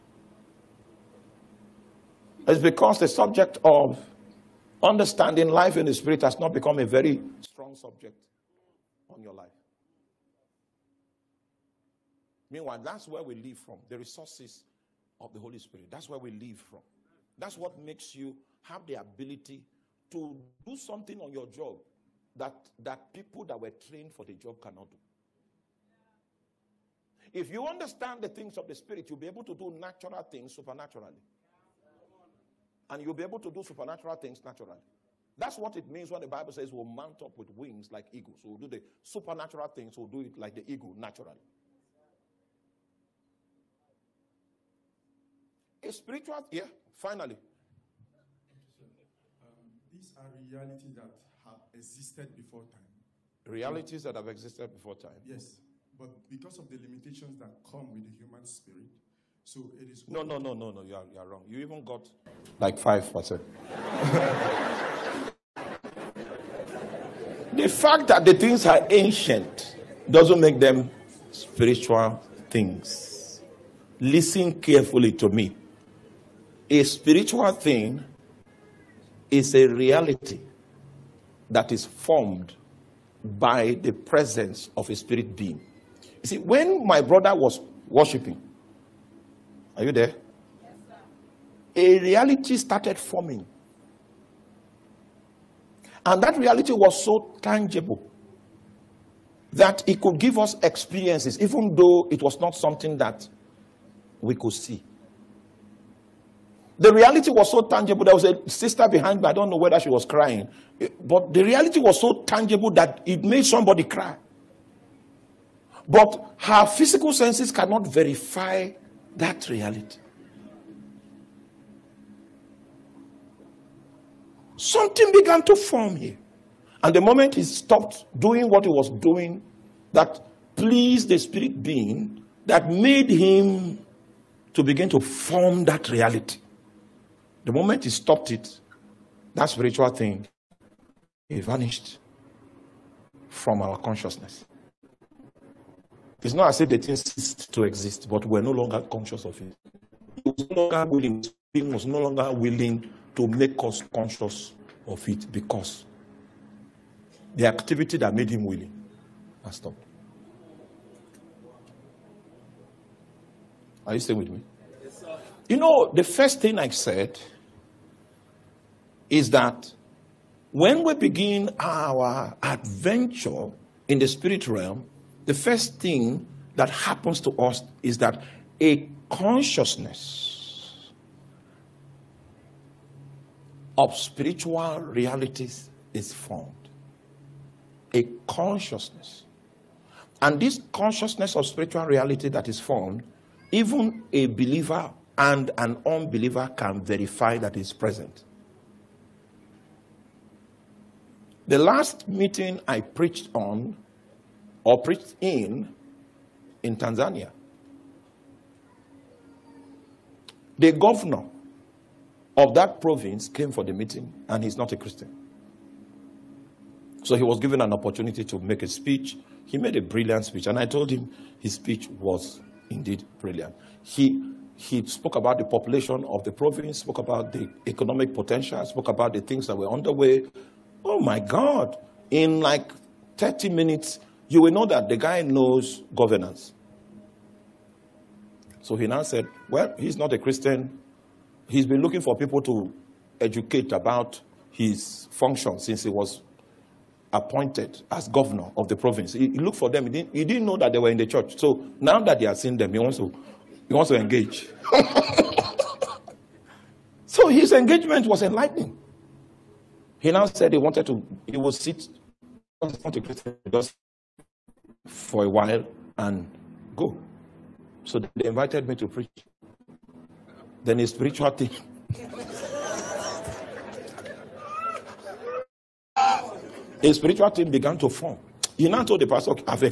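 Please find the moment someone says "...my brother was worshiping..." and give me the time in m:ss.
1:26.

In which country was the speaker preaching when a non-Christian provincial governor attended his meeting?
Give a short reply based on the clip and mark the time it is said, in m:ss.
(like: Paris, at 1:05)
Tanzania, at 3:26.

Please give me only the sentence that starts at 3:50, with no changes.
Oh my God, in like 30 minutes, you will know that the guy knows governance.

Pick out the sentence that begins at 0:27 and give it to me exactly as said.
If you understand the things of the Spirit, you'll be able to do natural things supernaturally.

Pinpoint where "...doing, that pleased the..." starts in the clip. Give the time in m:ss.
2:09.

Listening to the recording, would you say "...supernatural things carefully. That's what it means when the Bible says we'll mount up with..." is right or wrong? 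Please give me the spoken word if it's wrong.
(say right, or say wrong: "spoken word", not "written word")
wrong: "naturally", not "carefully".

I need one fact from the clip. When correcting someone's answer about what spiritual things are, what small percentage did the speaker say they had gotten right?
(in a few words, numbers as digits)
5%.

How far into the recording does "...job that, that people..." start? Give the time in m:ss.
0:21.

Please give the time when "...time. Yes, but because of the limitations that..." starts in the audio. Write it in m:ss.
0:54.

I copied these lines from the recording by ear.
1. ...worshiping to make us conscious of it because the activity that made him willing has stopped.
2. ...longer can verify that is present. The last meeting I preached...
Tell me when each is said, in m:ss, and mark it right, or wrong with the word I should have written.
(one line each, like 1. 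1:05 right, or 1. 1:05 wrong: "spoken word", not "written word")
1. 2:32 wrong: "willing", not "worshiping"
2. 3:15 wrong: "unbeliever", not "longer".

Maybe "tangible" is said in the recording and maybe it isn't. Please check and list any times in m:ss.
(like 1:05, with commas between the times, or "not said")
1:37, 1:47, 1:52.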